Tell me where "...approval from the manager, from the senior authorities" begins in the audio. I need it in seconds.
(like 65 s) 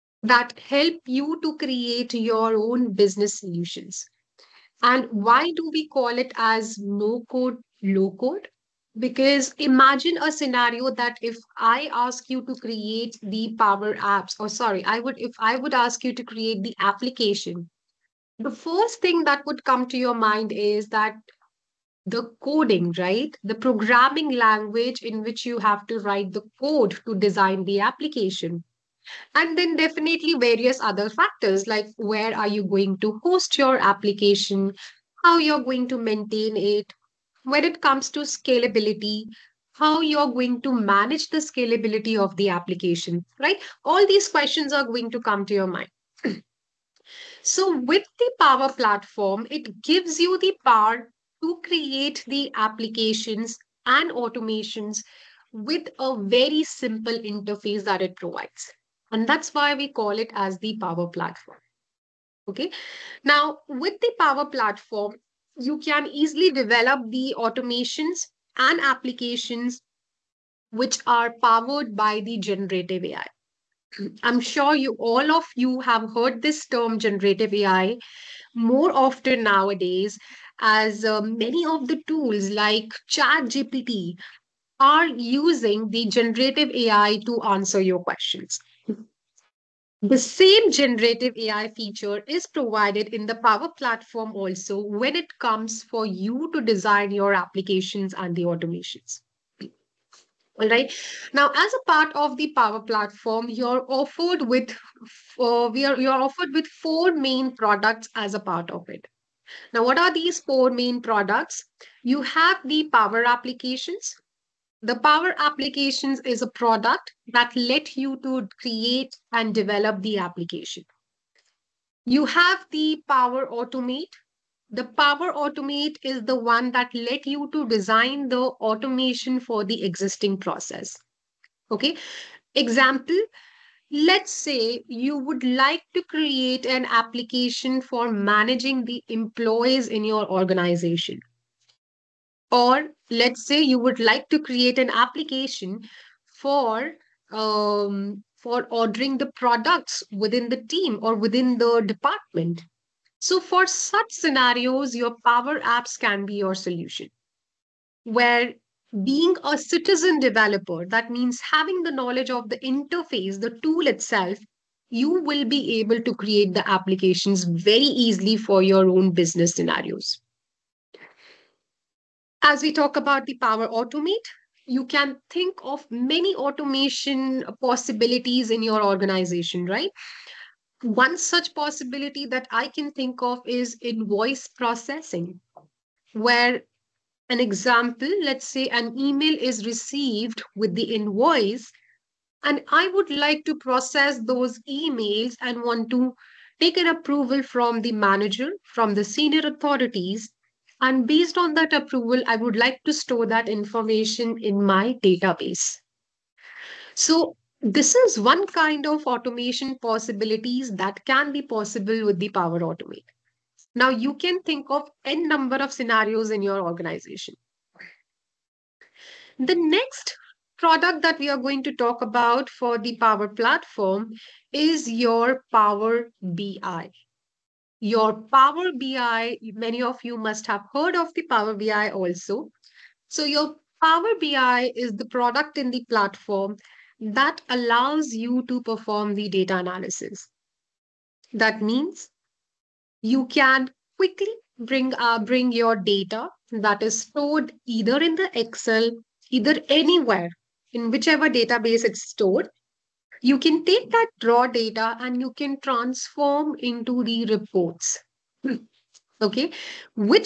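196 s.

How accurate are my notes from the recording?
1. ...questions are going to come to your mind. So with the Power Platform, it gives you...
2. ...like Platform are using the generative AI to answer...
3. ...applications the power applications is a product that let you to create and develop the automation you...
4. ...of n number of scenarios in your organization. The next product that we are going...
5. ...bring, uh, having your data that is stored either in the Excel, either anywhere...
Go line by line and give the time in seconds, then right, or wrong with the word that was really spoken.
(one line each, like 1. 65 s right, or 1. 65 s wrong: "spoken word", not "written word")
1. 44 s right
2. 82 s wrong: "ChatGPT", not "Platform"
3. 113 s wrong: "application", not "automation"
4. 214 s right
5. 244 s wrong: "bring", not "having".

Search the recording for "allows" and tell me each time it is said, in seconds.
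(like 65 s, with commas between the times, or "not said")
237 s.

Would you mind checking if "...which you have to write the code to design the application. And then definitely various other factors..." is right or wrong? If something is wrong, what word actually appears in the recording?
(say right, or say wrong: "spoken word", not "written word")
right.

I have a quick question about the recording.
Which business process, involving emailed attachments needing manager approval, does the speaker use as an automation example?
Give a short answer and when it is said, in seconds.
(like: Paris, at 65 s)
Invoice processing, at 183 s.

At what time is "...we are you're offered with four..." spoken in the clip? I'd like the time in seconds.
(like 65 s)
105 s.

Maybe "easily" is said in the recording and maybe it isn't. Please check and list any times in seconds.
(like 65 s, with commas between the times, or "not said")
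66 s, 168 s.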